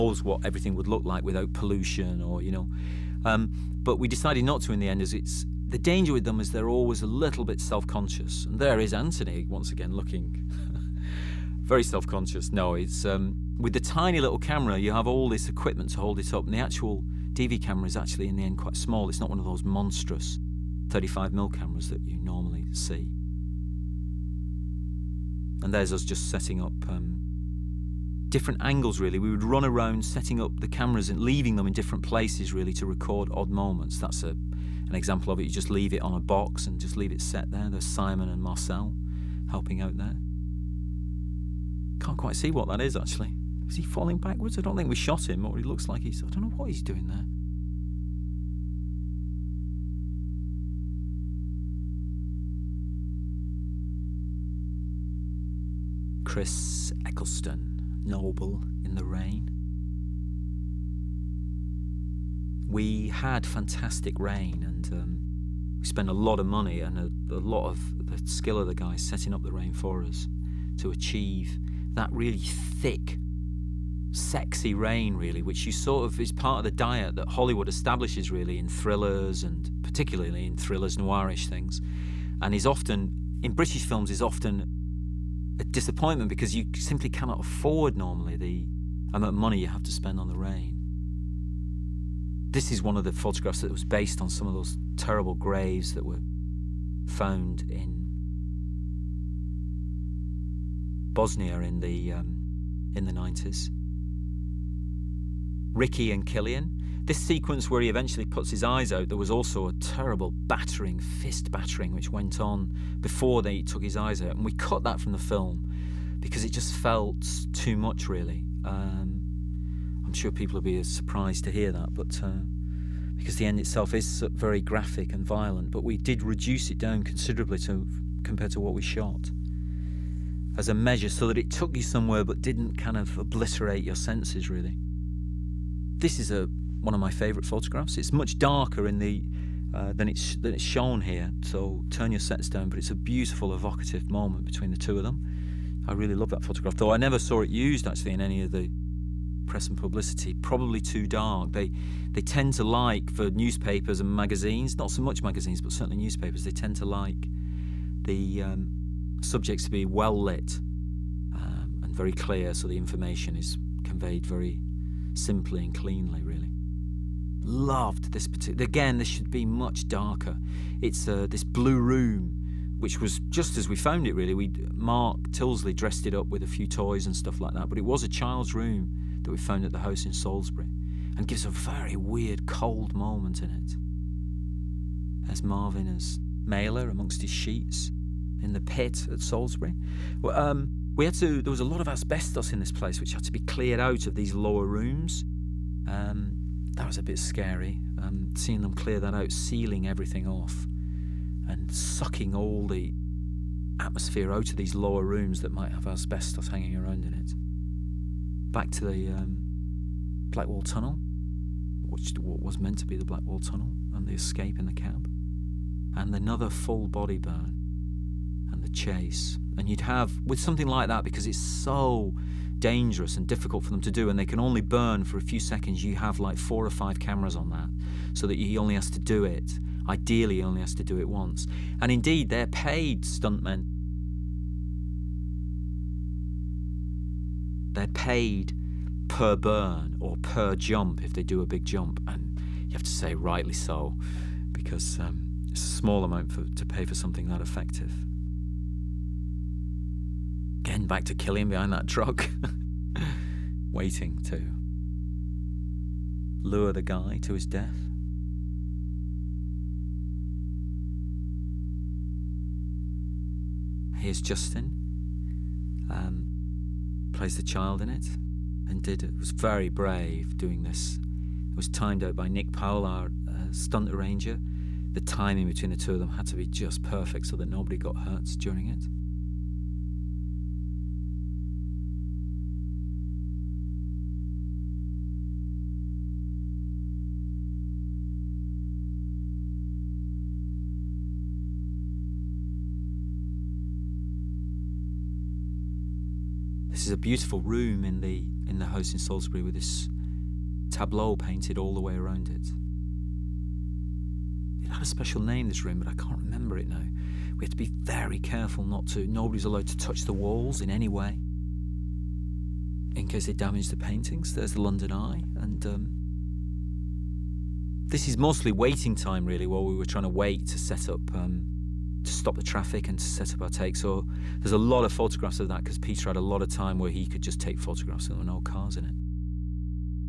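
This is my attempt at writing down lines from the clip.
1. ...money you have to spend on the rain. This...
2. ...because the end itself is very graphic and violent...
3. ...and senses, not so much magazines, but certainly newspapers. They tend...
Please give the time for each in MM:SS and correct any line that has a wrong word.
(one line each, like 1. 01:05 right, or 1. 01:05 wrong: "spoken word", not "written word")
1. 01:29 right
2. 02:03 right
3. 02:33 wrong: "magazines", not "senses".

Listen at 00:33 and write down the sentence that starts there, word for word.
That's a, an example of it.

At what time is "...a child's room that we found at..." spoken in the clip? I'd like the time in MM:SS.
02:58.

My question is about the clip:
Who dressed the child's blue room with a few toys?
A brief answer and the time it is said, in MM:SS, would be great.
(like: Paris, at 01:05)
Mark Tildesley, at 02:54.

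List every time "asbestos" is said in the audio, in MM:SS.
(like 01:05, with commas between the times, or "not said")
03:11, 03:25.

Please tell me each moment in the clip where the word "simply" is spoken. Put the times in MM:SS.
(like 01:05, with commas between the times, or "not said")
01:26, 02:45.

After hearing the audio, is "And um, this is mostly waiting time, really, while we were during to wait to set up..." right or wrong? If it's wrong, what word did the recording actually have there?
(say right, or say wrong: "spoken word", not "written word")
wrong: "trying", not "during".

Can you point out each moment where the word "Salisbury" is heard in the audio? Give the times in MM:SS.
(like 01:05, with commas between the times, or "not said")
03:00, 03:09, 04:58.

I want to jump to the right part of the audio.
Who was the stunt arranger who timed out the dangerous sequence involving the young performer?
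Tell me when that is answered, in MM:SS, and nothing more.
04:32.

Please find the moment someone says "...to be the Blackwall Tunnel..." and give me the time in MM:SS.
03:32.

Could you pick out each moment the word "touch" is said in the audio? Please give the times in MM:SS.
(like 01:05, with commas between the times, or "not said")
05:09.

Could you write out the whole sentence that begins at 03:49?
Ideally, he only has to do it once.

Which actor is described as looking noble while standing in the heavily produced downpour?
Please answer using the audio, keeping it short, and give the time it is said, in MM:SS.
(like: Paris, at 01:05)
Chris Eccleston, at 00:56.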